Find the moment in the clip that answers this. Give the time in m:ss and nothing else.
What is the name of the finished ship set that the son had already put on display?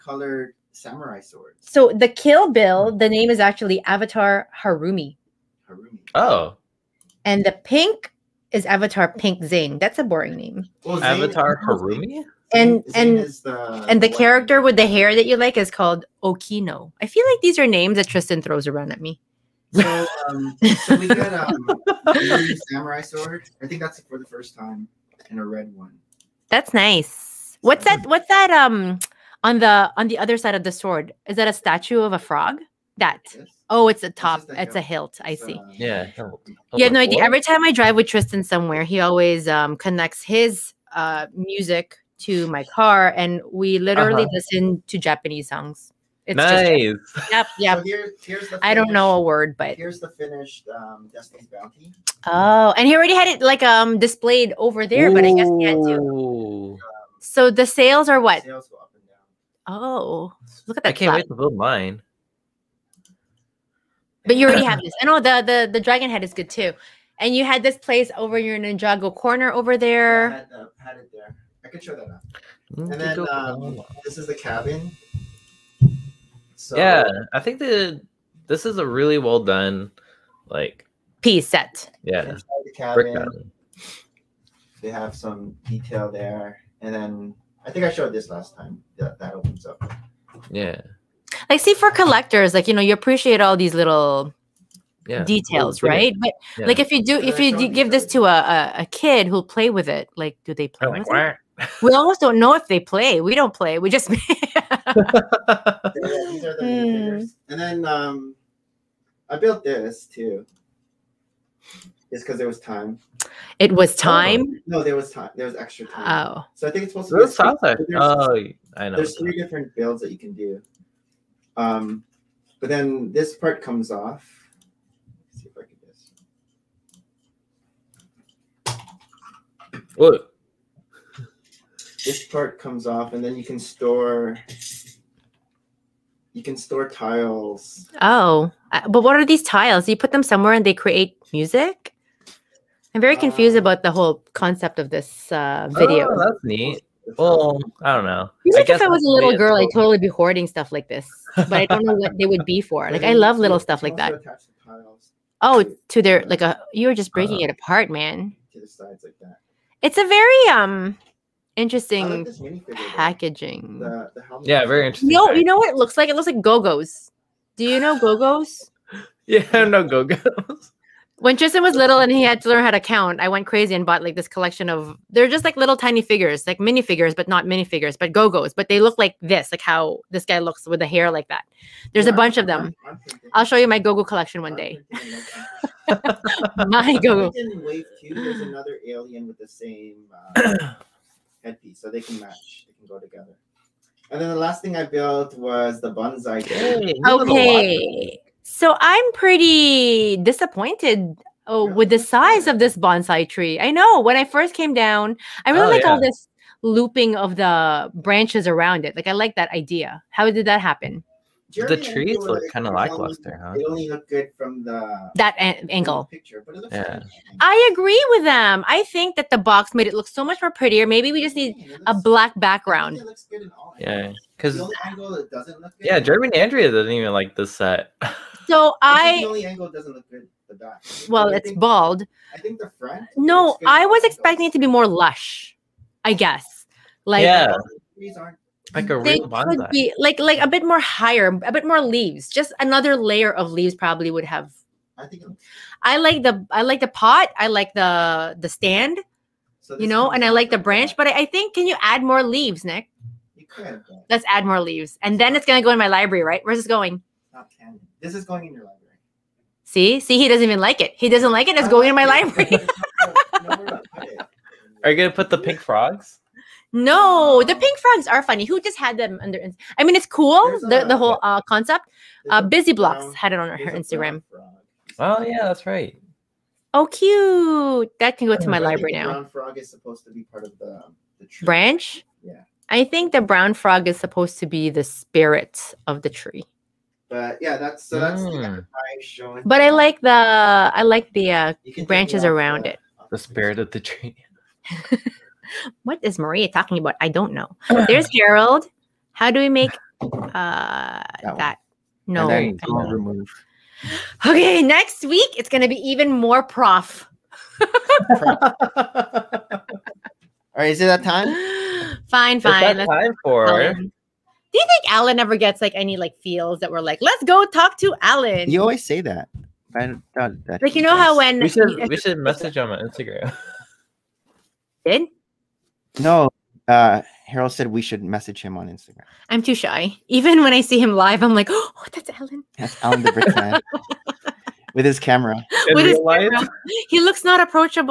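0:51.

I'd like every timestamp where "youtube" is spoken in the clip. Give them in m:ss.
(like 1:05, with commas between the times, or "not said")
not said.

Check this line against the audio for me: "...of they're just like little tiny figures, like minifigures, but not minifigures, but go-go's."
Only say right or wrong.
right.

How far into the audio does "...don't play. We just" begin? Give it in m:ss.
1:43.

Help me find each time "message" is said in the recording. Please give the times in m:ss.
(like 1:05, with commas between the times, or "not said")
5:22, 5:28.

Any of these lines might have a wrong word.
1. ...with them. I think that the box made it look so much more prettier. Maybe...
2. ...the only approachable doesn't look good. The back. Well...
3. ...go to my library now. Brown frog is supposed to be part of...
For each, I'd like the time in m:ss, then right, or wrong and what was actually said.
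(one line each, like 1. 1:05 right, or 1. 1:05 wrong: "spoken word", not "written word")
1. 3:38 right
2. 3:49 wrong: "angle", not "approachable"
3. 4:38 right.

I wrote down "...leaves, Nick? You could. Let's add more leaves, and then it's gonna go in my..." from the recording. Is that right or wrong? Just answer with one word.
right.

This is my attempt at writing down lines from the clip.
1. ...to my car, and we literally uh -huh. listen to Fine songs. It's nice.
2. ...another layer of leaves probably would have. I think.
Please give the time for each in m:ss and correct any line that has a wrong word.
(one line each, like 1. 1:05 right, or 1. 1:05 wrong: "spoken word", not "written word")
1. 0:42 wrong: "Japanese", not "Fine"
2. 4:02 right.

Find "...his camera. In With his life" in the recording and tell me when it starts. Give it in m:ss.
5:34.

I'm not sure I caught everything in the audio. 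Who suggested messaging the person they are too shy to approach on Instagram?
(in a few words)
Harold.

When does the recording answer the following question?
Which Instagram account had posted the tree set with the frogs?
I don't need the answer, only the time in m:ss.
4:32.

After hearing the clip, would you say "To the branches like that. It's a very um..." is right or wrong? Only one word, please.
wrong.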